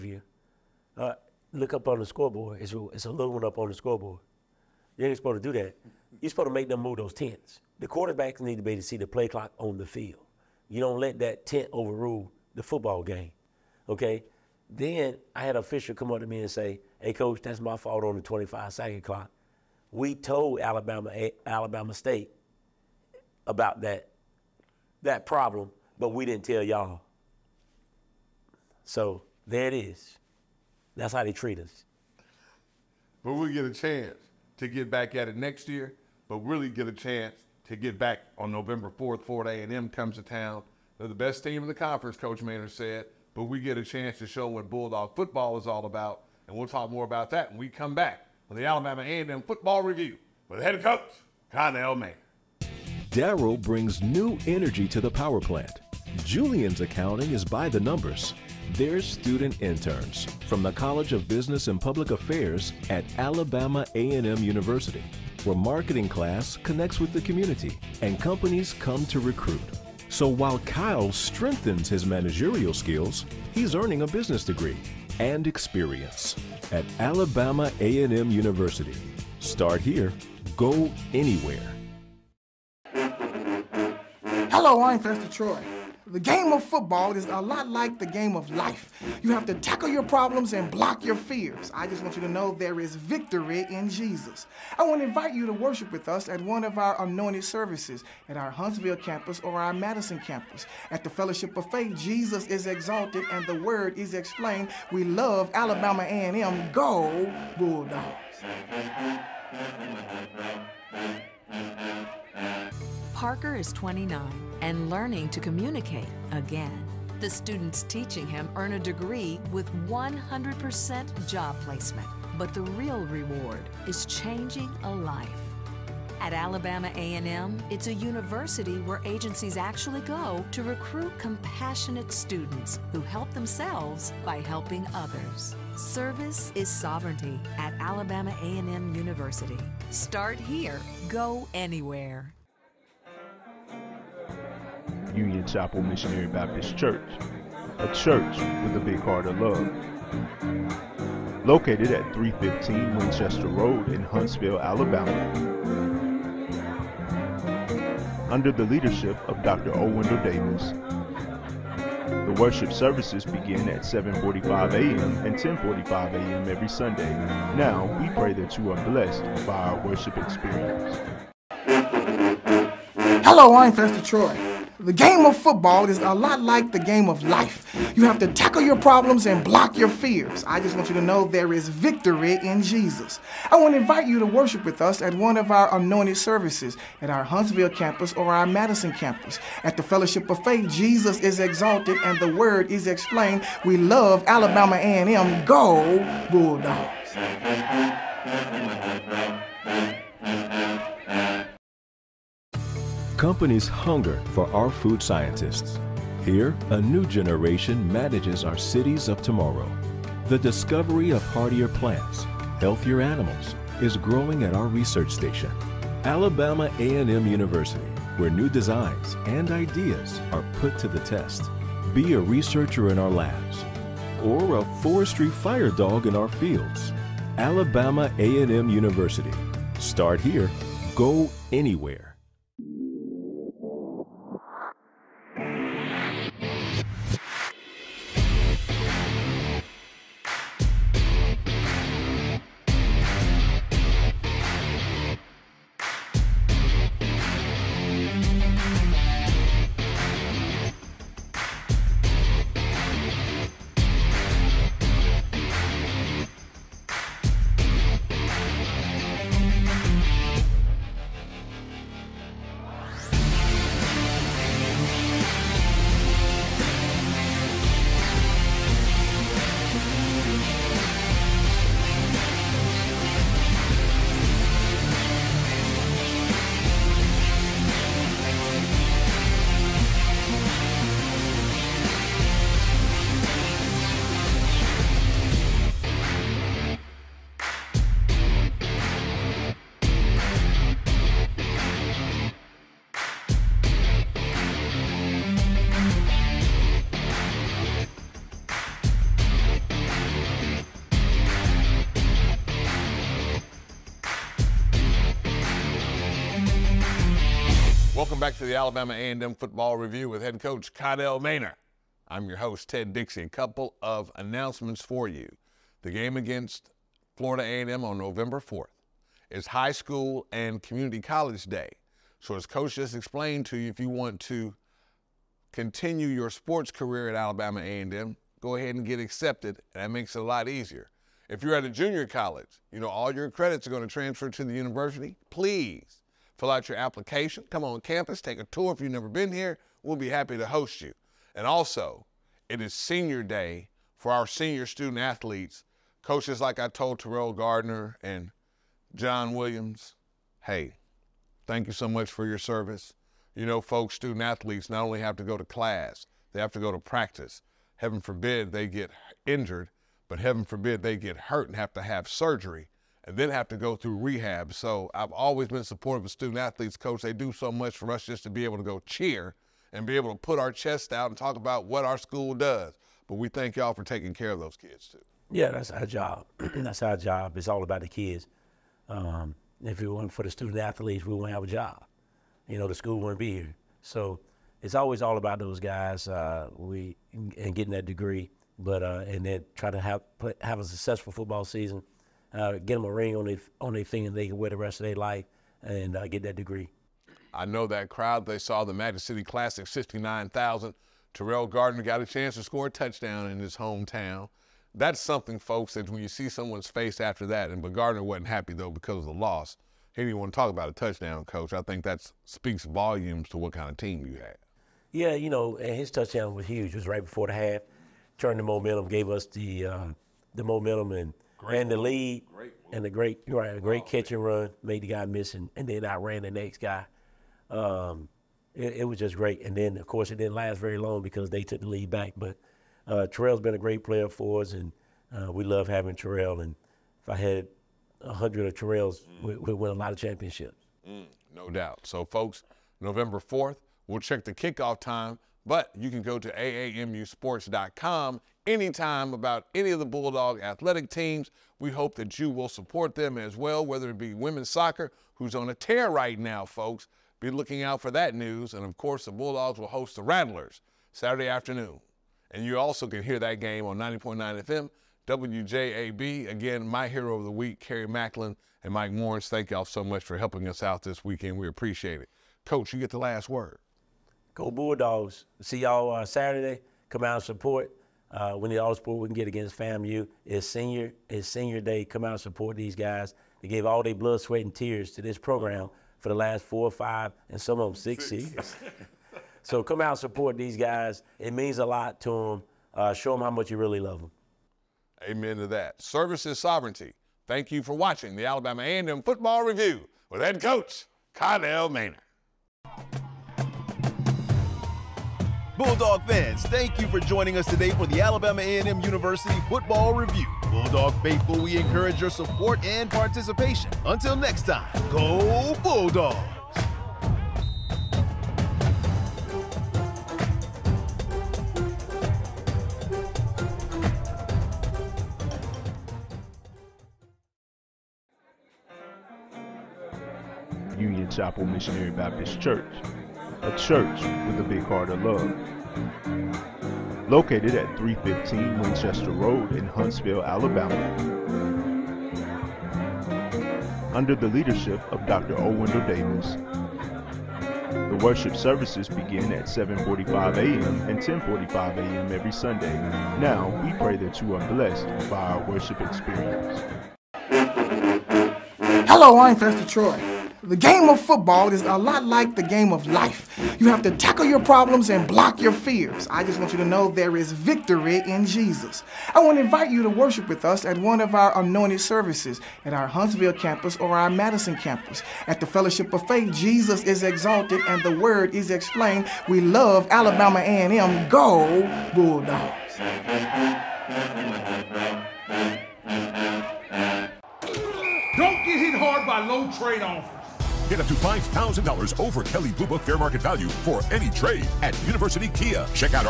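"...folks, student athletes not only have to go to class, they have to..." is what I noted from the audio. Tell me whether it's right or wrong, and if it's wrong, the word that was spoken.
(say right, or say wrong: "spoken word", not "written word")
right.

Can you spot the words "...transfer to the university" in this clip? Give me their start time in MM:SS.
05:33.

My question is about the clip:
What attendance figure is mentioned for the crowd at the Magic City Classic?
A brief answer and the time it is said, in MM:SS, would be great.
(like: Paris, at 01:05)
69,000, at 06:39.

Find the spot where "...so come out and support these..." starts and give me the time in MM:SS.
08:09.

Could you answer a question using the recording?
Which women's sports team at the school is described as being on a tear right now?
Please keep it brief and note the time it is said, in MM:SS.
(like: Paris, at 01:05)
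women's soccer, at 07:34.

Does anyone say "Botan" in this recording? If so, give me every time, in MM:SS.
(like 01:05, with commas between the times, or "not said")
not said.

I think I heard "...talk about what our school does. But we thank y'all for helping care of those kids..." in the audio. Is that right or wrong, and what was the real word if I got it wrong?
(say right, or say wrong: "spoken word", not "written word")
wrong: "taking", not "helping".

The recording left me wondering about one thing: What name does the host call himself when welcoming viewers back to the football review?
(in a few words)
Ted Dixie.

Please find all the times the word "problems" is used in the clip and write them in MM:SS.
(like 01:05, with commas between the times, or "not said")
00:25, 01:30, 02:58, 09:24.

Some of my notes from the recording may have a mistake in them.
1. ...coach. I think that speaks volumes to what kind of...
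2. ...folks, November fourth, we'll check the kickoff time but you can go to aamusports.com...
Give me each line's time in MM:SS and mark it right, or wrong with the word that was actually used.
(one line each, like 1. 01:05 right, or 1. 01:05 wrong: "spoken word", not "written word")
1. 06:51 right
2. 07:22 right.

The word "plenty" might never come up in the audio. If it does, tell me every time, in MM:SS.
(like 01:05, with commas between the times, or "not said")
not said.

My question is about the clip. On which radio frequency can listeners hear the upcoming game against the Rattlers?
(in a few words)
90.9 FM.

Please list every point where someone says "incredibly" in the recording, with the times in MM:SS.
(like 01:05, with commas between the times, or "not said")
not said.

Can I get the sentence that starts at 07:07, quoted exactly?
Um, it, it, was just great, and then of course it didn't last very long because they took the lead back.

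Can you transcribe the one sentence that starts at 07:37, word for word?
Be looking out for that news.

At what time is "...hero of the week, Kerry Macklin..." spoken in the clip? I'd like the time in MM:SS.
07:46.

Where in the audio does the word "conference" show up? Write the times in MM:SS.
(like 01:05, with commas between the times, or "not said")
00:41.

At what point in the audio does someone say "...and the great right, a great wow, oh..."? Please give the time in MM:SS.
07:02.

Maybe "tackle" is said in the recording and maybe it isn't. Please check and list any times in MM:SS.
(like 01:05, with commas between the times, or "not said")
01:29, 02:58, 09:23.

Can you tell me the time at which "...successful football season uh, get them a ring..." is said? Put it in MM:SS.
06:30.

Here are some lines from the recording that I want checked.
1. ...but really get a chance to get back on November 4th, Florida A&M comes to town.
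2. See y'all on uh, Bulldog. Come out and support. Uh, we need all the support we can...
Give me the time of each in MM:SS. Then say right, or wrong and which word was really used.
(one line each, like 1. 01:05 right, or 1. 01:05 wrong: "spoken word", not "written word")
1. 00:36 right
2. 07:55 wrong: "Saturday", not "Bulldog".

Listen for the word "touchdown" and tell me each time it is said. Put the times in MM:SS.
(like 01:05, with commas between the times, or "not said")
06:42, 06:50, 06:55.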